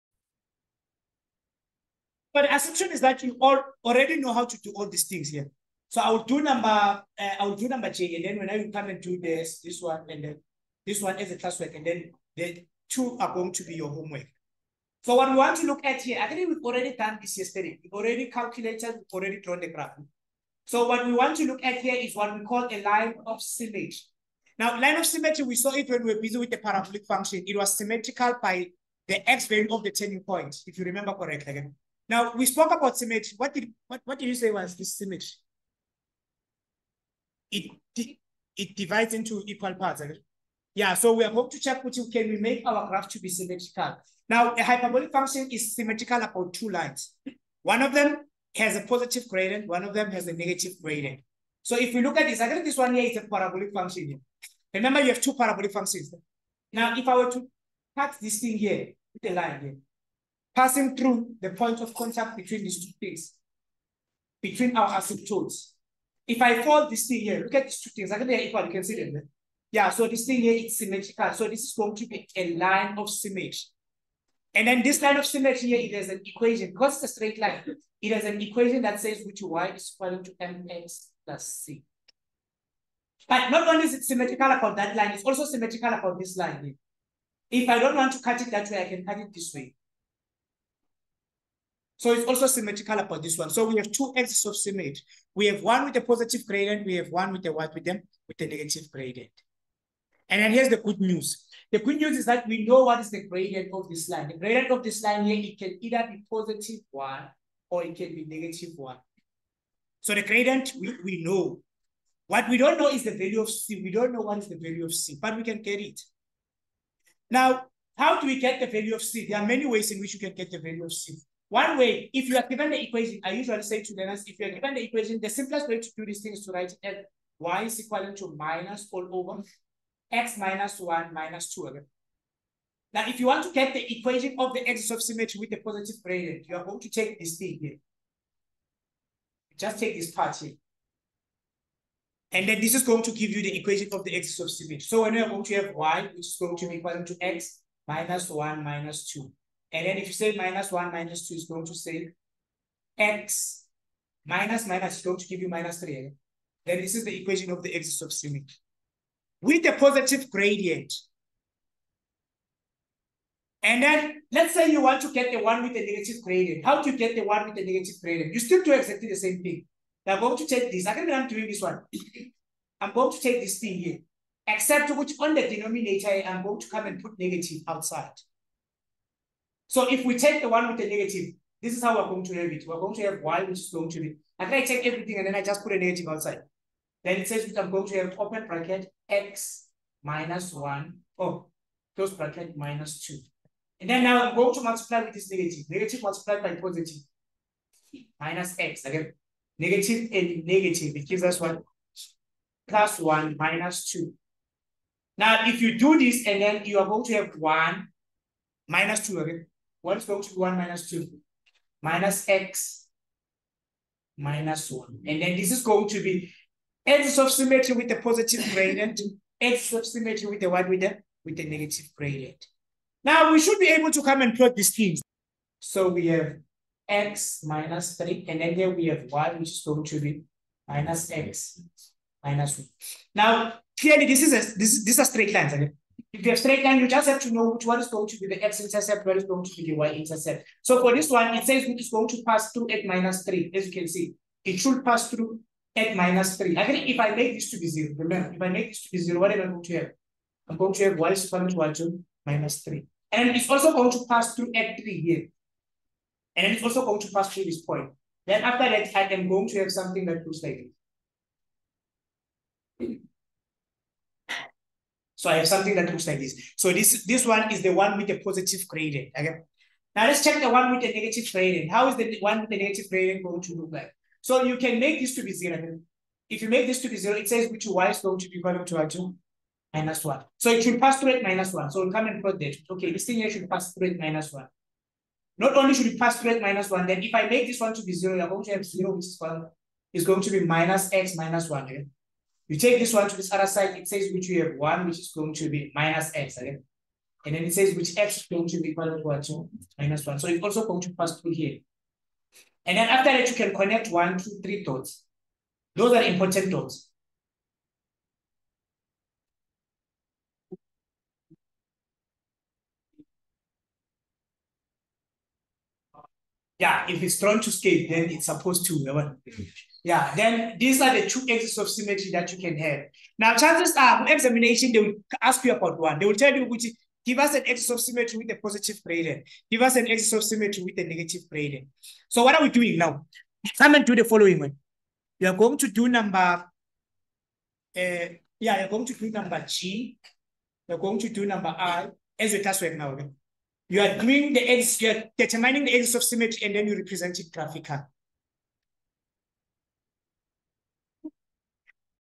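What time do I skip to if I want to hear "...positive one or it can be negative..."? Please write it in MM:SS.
01:46.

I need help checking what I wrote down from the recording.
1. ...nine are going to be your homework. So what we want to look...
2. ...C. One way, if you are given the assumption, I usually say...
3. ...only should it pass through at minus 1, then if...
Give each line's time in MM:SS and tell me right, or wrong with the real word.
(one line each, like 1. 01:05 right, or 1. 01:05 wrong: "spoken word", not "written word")
1. 00:12 wrong: "two", not "nine"
2. 02:00 wrong: "equation", not "assumption"
3. 04:45 right.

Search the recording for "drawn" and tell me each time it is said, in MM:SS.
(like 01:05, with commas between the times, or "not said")
00:19, 05:17.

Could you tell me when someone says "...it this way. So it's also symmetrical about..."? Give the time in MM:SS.
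01:29.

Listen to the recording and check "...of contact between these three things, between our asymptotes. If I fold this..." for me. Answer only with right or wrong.
wrong.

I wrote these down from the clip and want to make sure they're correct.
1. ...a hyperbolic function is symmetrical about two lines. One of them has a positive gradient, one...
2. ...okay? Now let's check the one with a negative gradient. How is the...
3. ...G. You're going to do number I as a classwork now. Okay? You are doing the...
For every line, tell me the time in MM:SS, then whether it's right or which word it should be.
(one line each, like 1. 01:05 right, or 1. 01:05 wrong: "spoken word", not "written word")
1. 00:44 right
2. 04:29 right
3. 05:39 right.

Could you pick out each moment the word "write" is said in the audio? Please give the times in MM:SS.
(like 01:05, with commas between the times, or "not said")
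02:06.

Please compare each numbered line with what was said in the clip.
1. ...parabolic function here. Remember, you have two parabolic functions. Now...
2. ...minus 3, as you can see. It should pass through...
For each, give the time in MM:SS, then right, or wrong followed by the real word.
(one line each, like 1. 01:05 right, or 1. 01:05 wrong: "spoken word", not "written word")
1. 00:53 right
2. 04:02 right.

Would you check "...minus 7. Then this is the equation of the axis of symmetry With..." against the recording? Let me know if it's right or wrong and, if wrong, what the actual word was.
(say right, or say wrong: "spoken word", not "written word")
wrong: "3", not "7".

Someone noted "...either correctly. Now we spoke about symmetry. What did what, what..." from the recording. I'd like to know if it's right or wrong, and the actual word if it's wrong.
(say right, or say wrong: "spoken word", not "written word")
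wrong: "remember", not "either".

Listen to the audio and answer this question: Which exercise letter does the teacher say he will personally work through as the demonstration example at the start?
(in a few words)
J.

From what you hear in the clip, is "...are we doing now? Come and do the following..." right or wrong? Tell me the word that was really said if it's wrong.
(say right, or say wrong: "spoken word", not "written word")
right.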